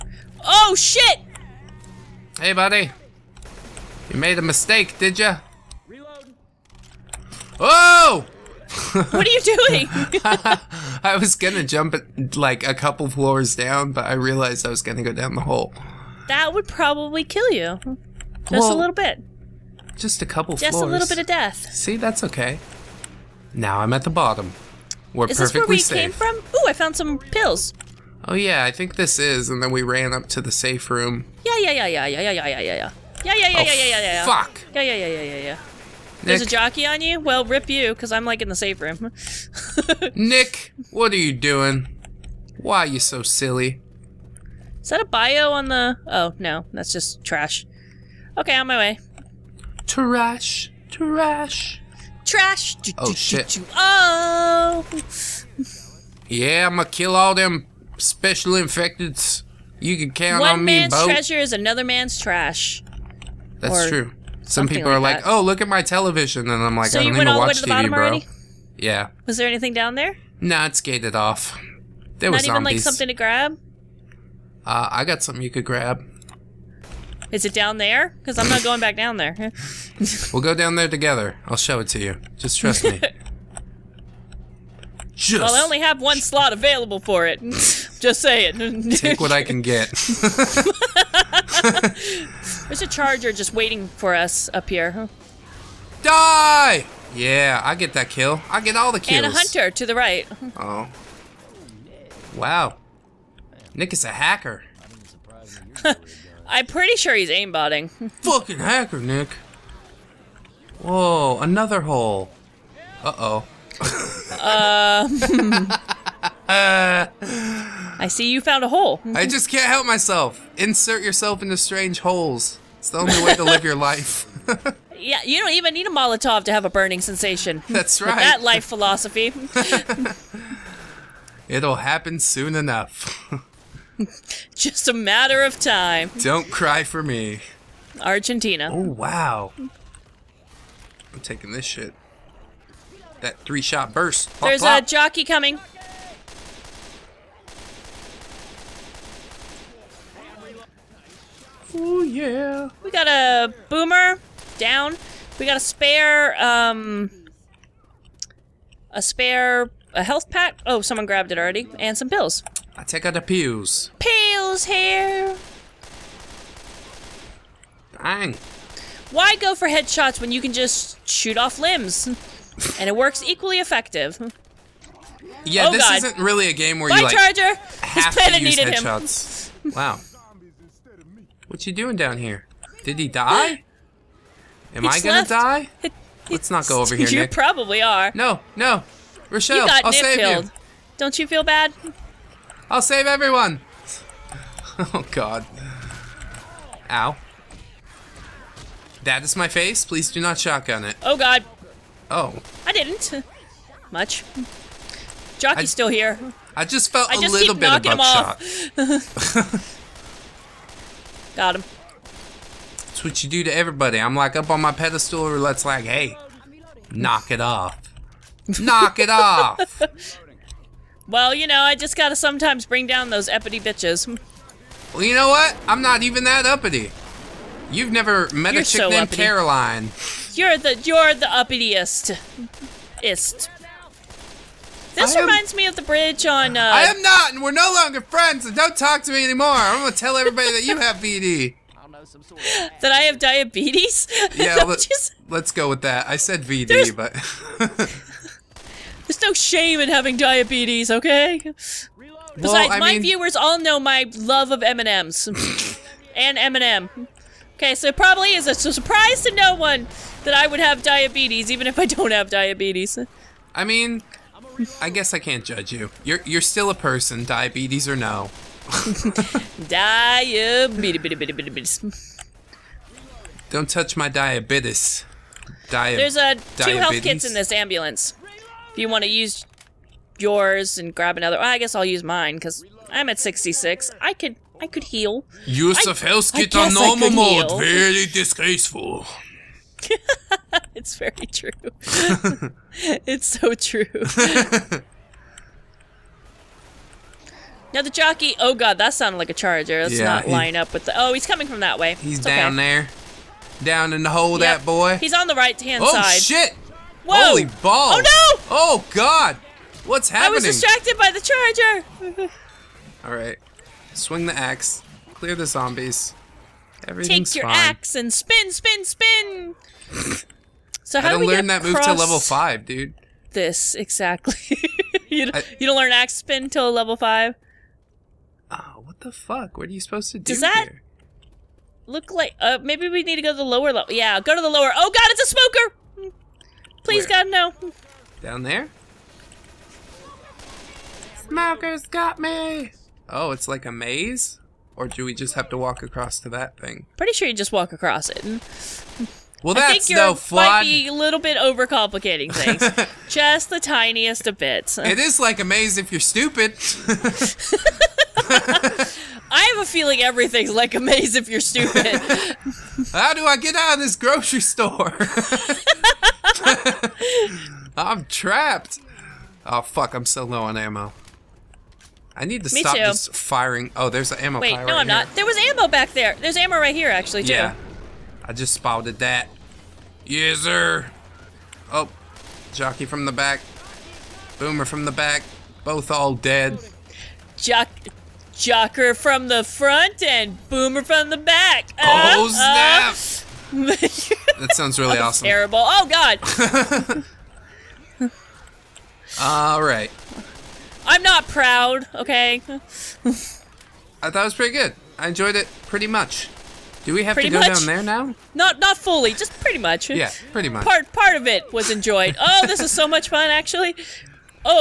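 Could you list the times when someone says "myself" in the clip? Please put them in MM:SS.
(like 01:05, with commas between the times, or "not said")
01:59.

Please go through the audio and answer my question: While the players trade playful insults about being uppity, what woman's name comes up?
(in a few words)
Caroline.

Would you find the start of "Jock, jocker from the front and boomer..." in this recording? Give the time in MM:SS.
06:27.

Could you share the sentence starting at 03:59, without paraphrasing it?
I'm gonna tell everybody that you have BD.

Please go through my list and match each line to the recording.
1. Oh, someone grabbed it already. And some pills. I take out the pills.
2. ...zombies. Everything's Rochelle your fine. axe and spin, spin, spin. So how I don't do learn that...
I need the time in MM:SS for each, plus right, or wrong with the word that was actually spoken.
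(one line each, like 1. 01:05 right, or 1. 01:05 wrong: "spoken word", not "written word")
1. 02:40 right
2. 05:15 wrong: "Take", not "Rochelle".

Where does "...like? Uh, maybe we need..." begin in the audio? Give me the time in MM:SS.
05:32.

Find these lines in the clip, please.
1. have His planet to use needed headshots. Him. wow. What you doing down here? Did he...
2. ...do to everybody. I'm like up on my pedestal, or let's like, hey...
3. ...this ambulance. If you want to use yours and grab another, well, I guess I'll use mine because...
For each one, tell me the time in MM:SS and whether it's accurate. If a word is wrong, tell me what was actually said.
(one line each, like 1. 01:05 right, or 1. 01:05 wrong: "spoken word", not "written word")
1. 02:57 right
2. 03:33 right
3. 04:37 right.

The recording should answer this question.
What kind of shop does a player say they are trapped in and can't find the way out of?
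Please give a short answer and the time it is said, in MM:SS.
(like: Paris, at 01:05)
Grocery store, at 06:03.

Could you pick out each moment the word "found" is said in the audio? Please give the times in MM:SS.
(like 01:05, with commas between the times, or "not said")
00:26, 01:58.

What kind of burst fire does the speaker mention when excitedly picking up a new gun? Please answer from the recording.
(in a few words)
Three shot burst.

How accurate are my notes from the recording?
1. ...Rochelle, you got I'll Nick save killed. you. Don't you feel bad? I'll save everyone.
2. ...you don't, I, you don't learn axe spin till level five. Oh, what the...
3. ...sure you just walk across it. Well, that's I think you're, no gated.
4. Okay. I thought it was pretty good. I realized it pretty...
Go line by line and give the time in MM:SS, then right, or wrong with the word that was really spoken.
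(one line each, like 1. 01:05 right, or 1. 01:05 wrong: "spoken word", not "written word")
1. 03:09 right
2. 05:25 right
3. 05:47 wrong: "flawed", not "gated"
4. 06:41 wrong: "enjoyed", not "realized".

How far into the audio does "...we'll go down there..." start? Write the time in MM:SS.
01:20.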